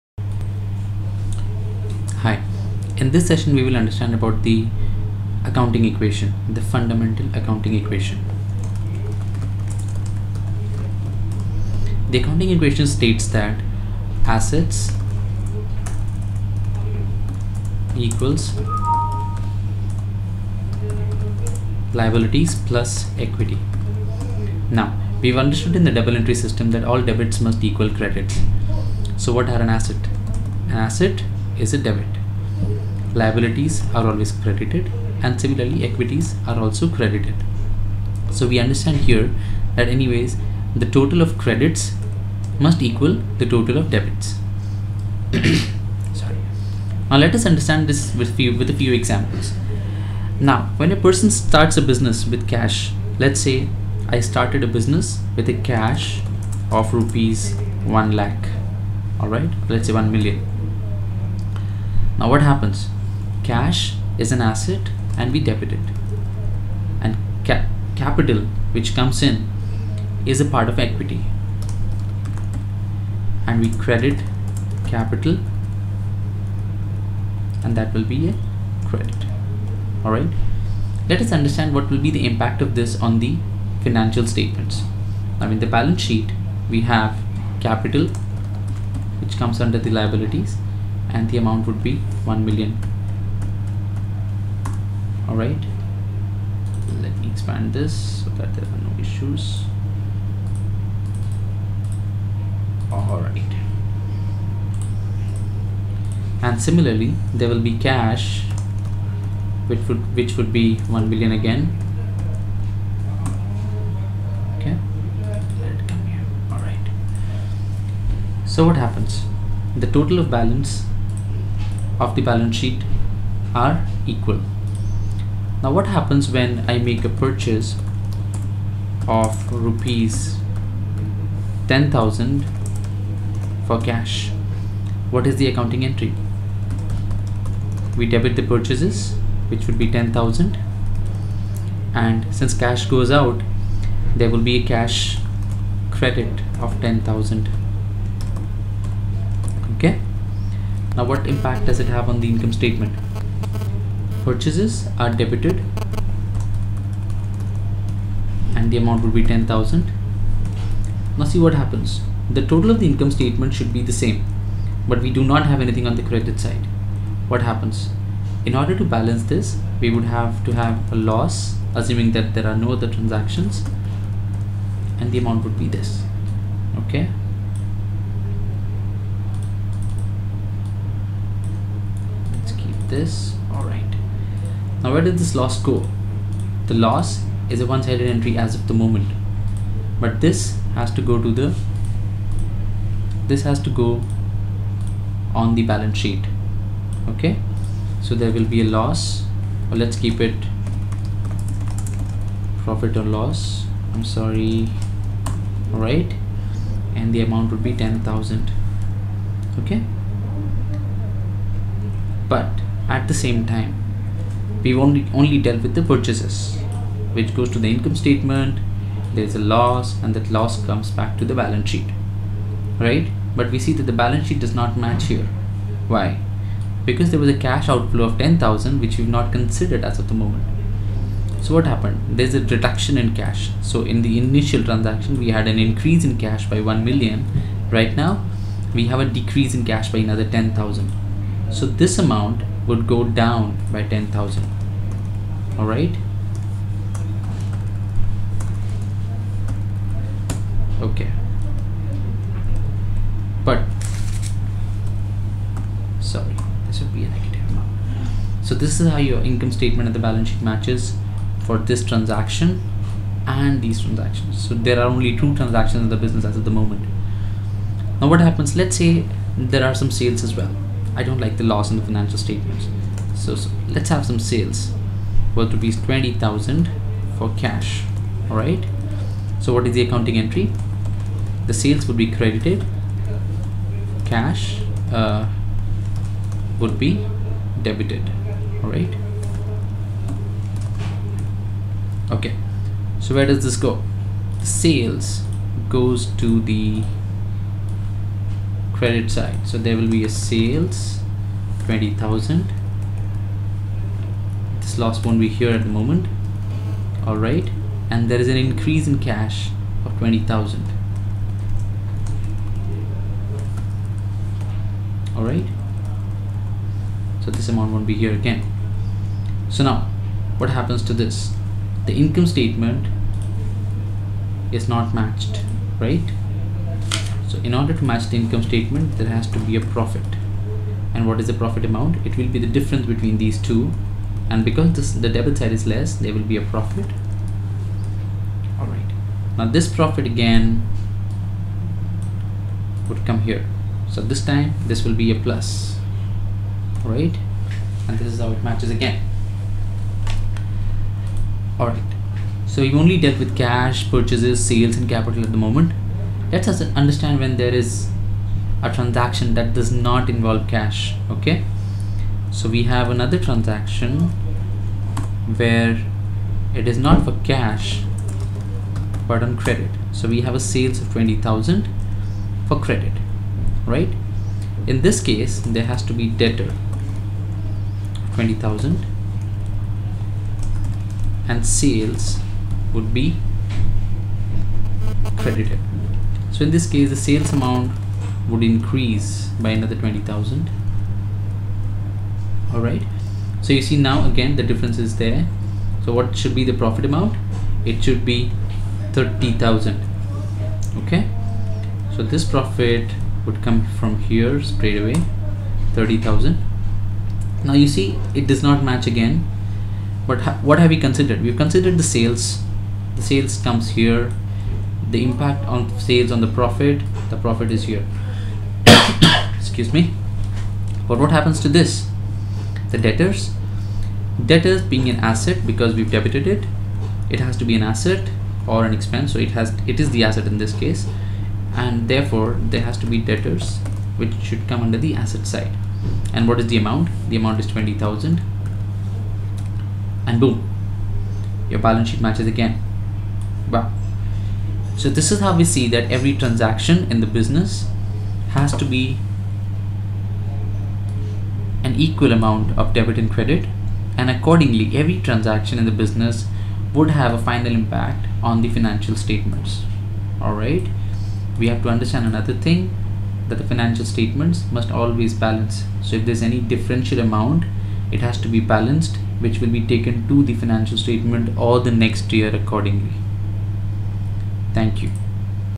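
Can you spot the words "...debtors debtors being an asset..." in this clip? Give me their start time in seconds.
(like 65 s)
422 s.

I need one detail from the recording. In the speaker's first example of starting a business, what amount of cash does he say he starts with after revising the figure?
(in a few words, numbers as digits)
1 million.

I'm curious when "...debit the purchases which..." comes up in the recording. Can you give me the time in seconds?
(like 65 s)
138 s.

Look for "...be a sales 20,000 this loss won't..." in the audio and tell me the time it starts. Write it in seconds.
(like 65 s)
299 s.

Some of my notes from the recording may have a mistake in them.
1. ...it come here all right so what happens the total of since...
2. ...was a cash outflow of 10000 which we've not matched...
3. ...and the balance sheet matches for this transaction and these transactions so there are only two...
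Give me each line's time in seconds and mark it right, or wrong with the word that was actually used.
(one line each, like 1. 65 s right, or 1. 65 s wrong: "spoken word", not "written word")
1. 115 s wrong: "balance", not "since"
2. 227 s wrong: "considered", not "matched"
3. 259 s right.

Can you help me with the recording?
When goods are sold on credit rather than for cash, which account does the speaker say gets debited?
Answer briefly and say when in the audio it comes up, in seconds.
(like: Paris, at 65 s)
Debtor, at 376 s.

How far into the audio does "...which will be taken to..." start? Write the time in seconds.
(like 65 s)
469 s.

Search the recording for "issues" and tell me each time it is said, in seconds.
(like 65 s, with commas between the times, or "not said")
99 s.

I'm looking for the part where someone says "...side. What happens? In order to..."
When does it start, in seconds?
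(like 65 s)
166 s.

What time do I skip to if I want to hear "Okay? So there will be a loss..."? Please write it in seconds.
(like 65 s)
197 s.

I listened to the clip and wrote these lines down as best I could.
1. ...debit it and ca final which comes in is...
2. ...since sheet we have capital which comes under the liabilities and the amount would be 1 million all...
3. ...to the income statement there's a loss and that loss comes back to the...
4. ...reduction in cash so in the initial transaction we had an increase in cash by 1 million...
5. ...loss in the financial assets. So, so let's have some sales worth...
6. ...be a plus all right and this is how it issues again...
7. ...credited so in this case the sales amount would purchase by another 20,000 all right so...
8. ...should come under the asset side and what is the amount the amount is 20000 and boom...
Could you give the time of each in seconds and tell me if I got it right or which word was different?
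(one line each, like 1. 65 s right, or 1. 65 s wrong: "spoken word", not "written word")
1. 65 s wrong: "capital", not "final"
2. 85 s wrong: "balance", not "since"
3. 217 s right
4. 232 s right
5. 271 s wrong: "statements", not "assets"
6. 344 s wrong: "matches", not "issues"
7. 385 s wrong: "increase", not "purchase"
8. 434 s right.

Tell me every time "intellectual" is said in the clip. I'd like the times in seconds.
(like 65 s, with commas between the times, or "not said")
not said.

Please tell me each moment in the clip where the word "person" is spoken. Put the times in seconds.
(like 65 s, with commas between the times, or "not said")
50 s.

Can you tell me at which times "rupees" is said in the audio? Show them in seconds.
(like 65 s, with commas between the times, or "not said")
56 s, 129 s, 275 s.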